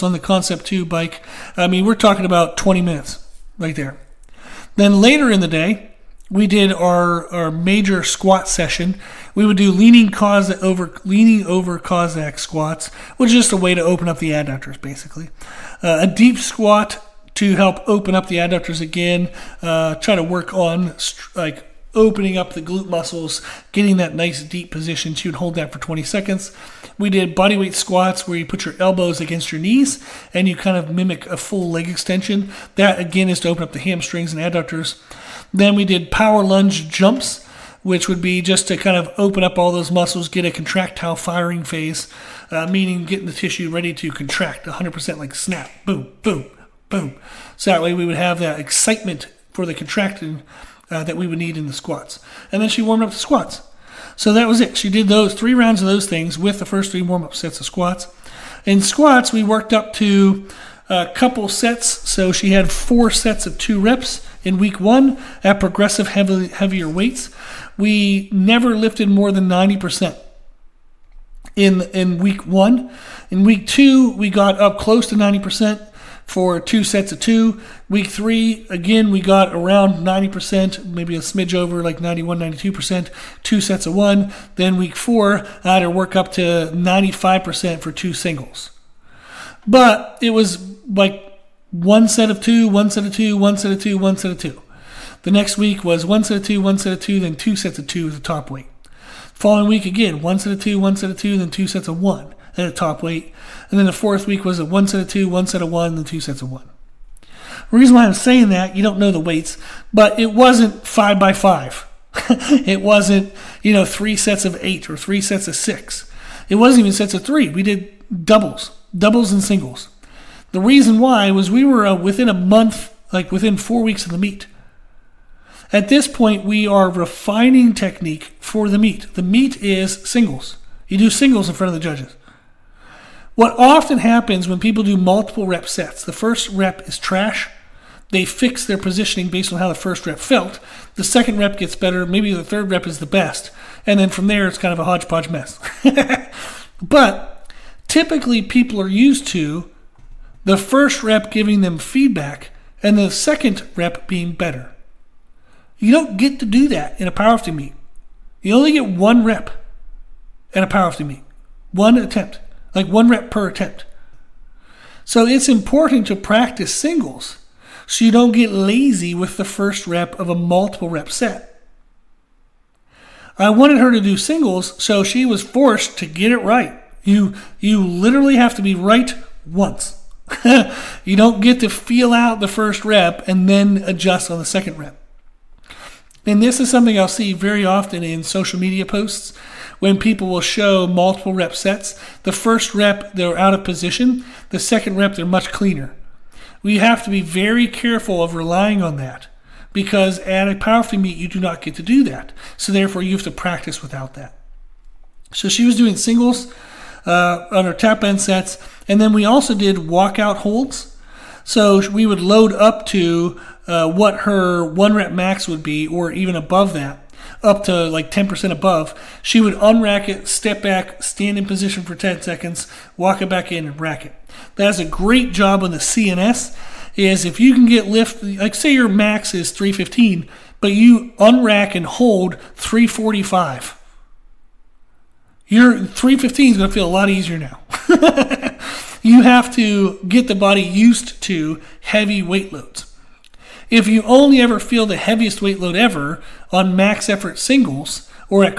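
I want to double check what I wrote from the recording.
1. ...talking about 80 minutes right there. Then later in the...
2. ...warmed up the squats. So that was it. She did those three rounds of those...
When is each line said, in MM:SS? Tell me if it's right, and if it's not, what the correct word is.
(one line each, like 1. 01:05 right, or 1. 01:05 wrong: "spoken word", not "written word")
1. 00:01 wrong: "20", not "80"
2. 00:52 right.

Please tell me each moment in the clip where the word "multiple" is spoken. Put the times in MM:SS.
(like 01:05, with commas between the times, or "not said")
02:14, 02:50, 03:10.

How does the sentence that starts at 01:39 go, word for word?
Following week again, one set of two, one set of two, then two sets of one at a top weight.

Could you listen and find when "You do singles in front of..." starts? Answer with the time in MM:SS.
02:10.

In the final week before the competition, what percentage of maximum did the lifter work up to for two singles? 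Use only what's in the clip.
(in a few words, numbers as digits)
95%.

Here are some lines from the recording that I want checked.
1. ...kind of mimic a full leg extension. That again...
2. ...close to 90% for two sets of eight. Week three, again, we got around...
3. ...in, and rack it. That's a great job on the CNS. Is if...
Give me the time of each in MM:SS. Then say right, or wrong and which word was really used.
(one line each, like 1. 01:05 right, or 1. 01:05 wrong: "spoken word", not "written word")
1. 00:30 right
2. 01:14 wrong: "two", not "eight"
3. 03:43 right.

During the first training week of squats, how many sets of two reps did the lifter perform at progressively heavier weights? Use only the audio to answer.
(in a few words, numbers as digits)
4.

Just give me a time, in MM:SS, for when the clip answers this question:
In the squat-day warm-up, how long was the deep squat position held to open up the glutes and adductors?
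00:25.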